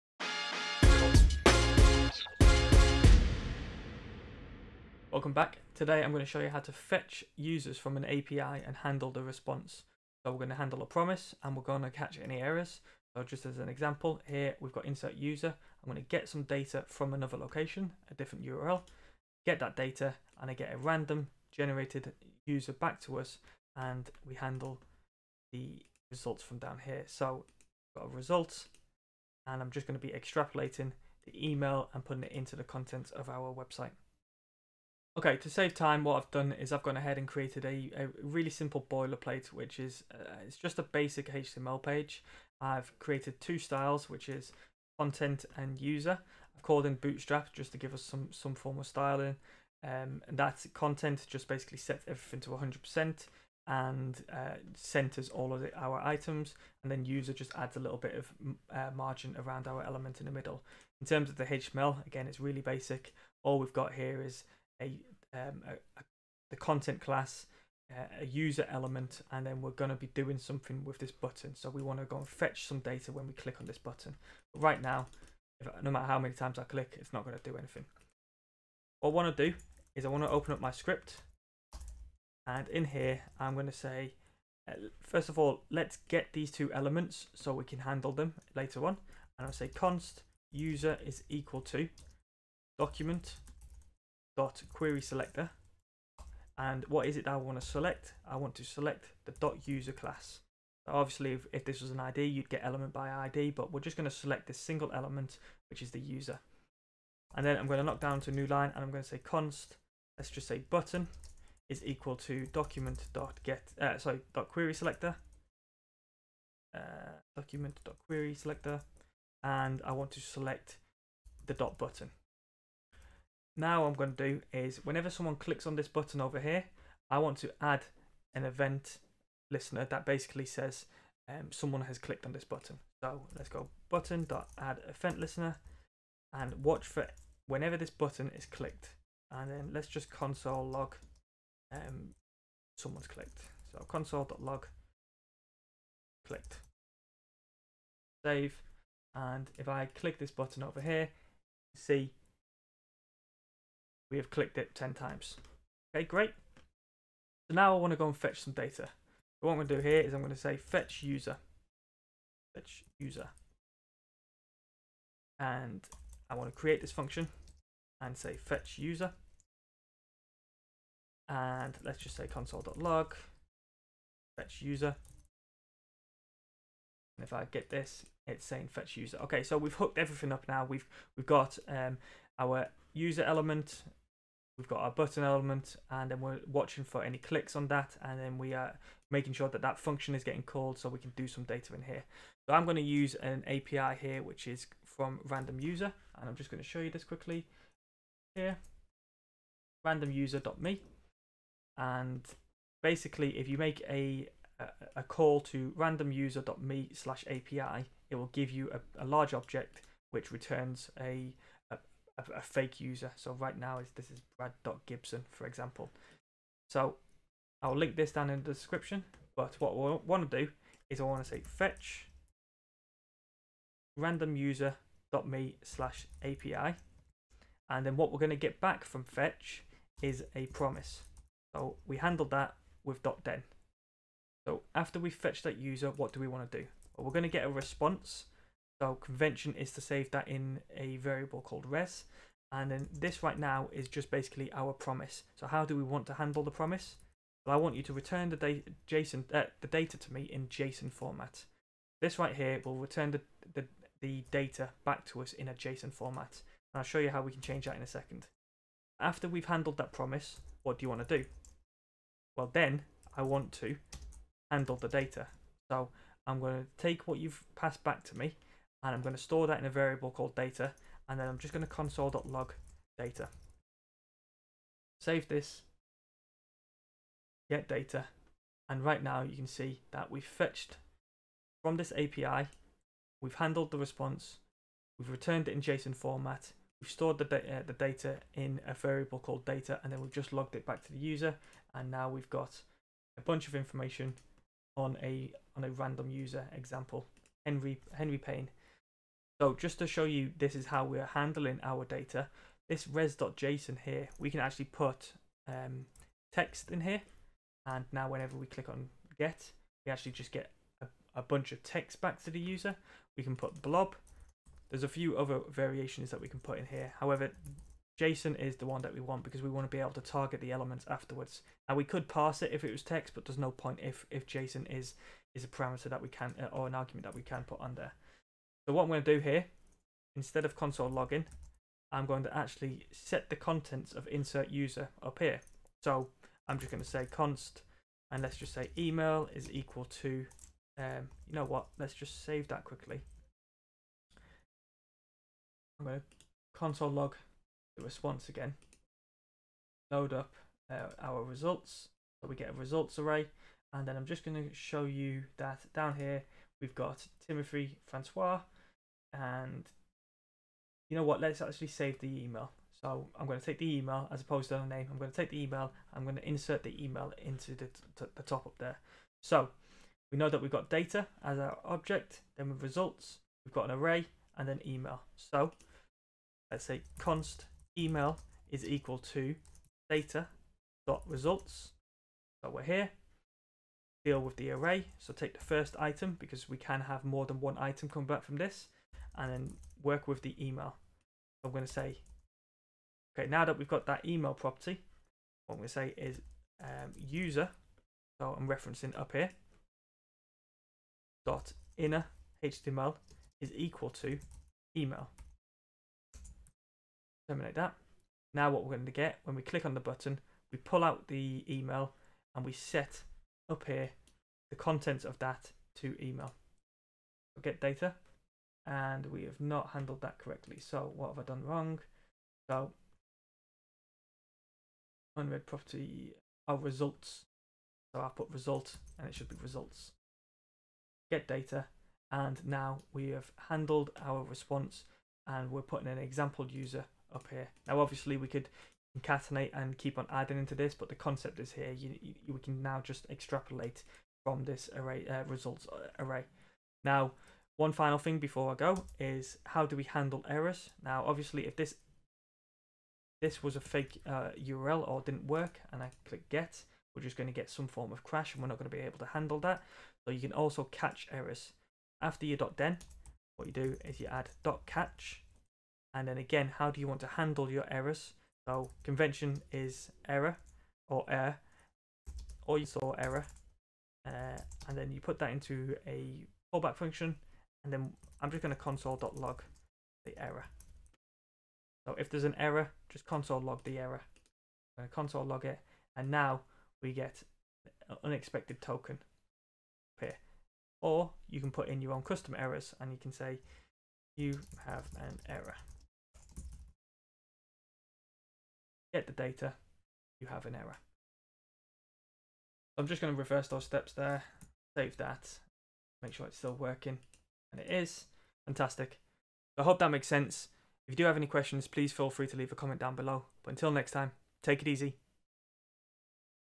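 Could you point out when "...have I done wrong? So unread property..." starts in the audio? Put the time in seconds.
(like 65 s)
421 s.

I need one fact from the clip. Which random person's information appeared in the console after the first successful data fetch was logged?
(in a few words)
Henry Payne.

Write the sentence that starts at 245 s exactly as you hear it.
So how do we want to handle the promise?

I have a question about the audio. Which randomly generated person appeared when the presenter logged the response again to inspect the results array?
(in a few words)
Timothy Francois.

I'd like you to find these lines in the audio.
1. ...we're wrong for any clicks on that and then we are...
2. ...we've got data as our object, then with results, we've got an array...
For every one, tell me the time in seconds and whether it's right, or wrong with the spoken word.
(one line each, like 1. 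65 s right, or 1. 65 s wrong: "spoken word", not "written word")
1. 186 s wrong: "watching", not "wrong"
2. 370 s right.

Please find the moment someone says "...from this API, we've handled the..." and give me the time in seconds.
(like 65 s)
281 s.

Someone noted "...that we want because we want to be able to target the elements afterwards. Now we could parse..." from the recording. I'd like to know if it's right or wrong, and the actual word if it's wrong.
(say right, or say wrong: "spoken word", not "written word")
right.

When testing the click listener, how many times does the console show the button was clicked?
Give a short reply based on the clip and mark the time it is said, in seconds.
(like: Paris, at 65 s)
10, at 154 s.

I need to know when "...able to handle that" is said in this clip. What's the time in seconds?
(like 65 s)
458 s.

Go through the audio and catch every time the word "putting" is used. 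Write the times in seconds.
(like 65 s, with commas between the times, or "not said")
32 s, 435 s.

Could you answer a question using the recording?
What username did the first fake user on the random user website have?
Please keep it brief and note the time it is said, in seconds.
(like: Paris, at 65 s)
brad.gibson, at 214 s.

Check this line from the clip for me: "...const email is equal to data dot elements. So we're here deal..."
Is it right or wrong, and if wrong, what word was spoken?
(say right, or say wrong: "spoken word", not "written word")
wrong: "results", not "elements".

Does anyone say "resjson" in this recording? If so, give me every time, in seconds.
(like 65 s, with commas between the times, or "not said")
302 s.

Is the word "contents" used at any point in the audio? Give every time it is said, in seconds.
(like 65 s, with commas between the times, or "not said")
32 s, 44 s, 50 s, 66 s, 333 s, 414 s.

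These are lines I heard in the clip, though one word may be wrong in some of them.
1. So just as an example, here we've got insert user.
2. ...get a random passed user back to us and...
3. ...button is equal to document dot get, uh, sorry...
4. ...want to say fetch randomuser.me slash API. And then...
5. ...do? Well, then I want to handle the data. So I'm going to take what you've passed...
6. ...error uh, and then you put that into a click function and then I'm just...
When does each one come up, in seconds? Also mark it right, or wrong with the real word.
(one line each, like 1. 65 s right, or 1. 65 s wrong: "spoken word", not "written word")
1. 13 s right
2. 20 s wrong: "generated", not "passed"
3. 110 s right
4. 221 s right
5. 261 s right
6. 472 s wrong: "callback", not "click".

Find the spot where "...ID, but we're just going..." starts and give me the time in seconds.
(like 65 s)
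103 s.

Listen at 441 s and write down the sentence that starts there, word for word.
You, you we can now just extrapolate from this array uh, results uh, array.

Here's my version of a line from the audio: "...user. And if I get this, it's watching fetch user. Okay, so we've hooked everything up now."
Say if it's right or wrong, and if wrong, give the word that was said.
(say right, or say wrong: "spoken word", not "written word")
wrong: "saying", not "watching".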